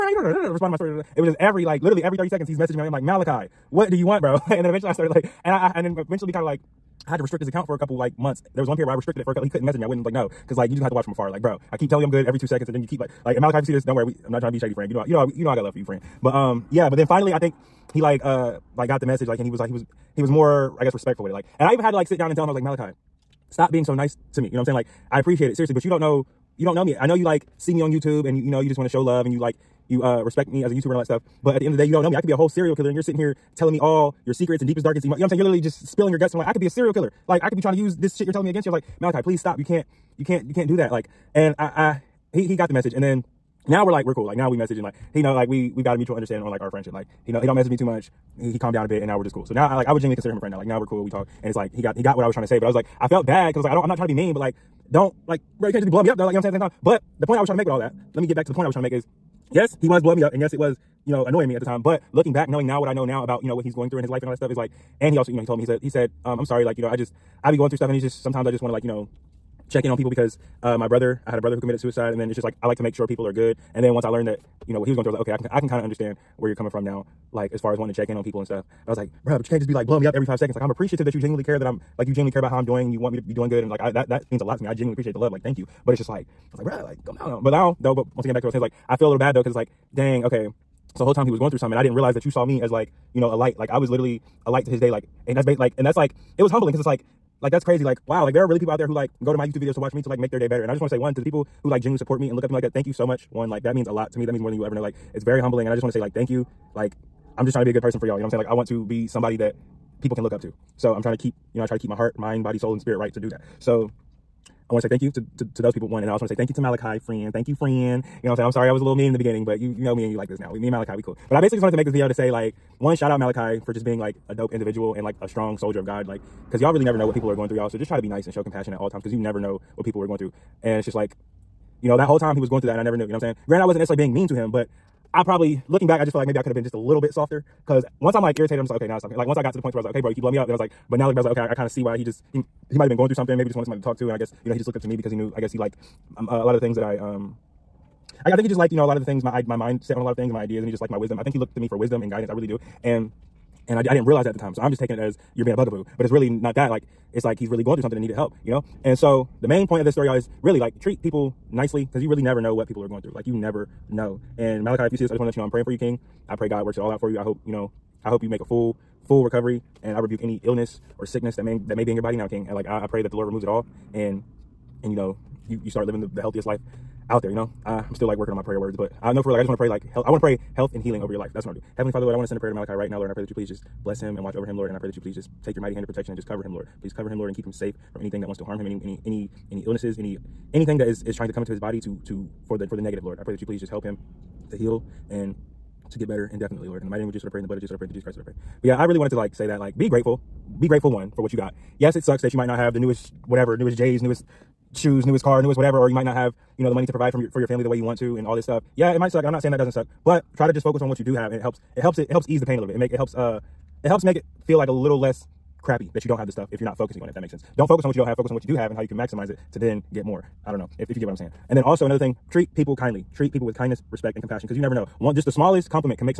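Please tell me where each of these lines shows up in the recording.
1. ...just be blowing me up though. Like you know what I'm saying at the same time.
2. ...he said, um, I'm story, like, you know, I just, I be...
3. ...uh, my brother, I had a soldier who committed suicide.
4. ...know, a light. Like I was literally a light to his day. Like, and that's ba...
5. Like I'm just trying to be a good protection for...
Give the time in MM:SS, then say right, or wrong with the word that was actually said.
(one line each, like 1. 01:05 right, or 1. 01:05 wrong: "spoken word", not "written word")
1. 00:55 right
2. 01:05 wrong: "sorry", not "story"
3. 01:10 wrong: "brother", not "soldier"
4. 01:33 right
5. 01:46 wrong: "person", not "protection".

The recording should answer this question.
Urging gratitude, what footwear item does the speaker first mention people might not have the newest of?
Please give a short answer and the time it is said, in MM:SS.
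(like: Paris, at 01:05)
newest J's, at 03:23.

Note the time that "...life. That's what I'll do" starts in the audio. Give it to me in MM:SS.
03:01.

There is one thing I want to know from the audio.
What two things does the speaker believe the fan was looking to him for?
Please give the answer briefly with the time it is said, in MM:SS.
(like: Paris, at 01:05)
wisdom and guidance, at 02:31.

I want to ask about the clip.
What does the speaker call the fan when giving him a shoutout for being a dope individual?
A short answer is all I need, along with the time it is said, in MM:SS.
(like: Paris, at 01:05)
soldier of God, at 02:05.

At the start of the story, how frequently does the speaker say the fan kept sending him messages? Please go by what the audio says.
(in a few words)
every 30 seconds.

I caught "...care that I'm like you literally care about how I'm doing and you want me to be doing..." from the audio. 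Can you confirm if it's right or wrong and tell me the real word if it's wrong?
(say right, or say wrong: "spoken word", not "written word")
wrong: "genuinely", not "literally".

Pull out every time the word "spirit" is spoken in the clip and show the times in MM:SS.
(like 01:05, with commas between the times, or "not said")
01:52.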